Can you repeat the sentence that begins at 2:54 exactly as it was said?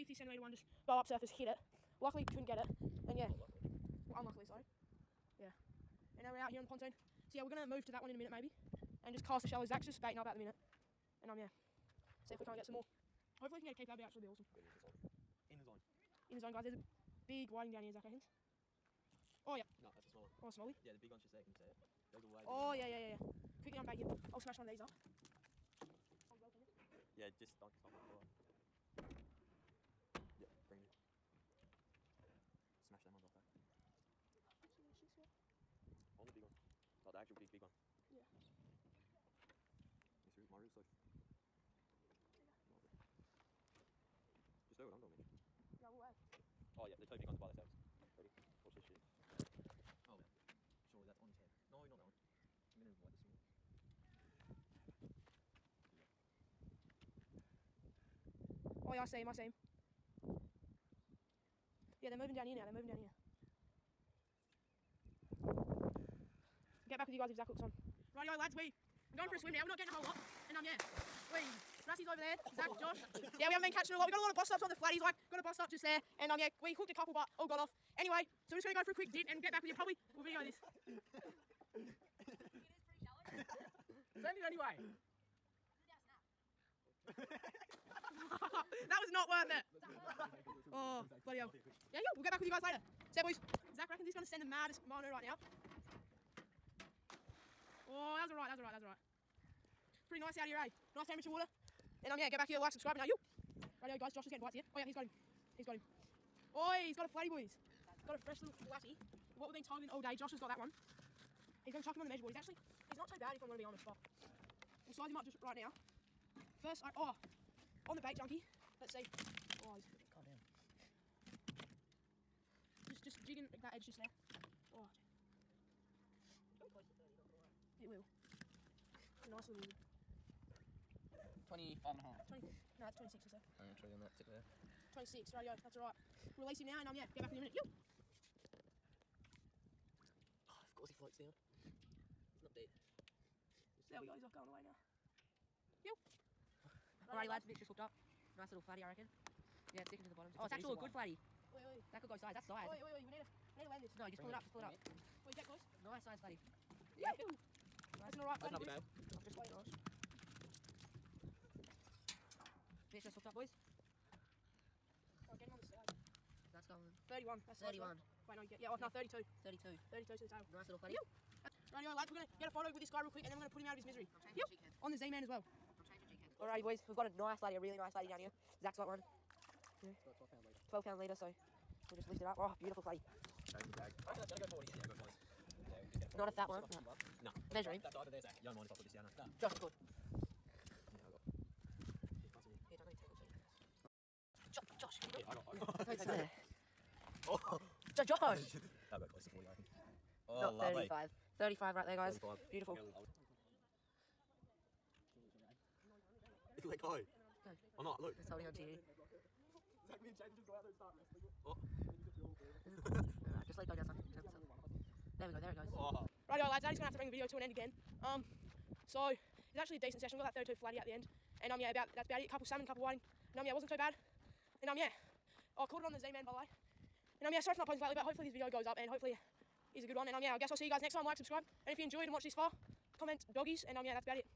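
I'm changing On the Z man as well.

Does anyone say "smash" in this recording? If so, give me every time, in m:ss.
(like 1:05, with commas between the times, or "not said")
0:24, 0:32.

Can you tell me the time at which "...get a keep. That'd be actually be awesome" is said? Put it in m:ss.
0:13.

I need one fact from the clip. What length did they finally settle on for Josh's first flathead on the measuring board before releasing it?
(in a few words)
26.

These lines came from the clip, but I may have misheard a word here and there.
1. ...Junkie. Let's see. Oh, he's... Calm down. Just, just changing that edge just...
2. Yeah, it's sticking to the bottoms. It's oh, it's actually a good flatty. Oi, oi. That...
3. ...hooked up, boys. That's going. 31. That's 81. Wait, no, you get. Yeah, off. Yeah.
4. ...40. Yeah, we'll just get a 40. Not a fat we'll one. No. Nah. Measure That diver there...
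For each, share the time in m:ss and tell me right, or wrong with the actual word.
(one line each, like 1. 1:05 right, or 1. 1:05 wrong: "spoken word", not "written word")
1. 1:58 wrong: "jigging", not "changing"
2. 2:29 right
3. 2:43 wrong: "31", not "81"
4. 3:04 right.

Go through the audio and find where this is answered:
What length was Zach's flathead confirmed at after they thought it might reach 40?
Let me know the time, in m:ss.
3:22.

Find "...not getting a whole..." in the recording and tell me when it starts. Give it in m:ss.
1:09.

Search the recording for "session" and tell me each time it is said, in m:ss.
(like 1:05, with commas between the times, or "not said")
3:39.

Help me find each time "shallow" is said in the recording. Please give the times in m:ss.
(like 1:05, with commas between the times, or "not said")
0:09, 1:23.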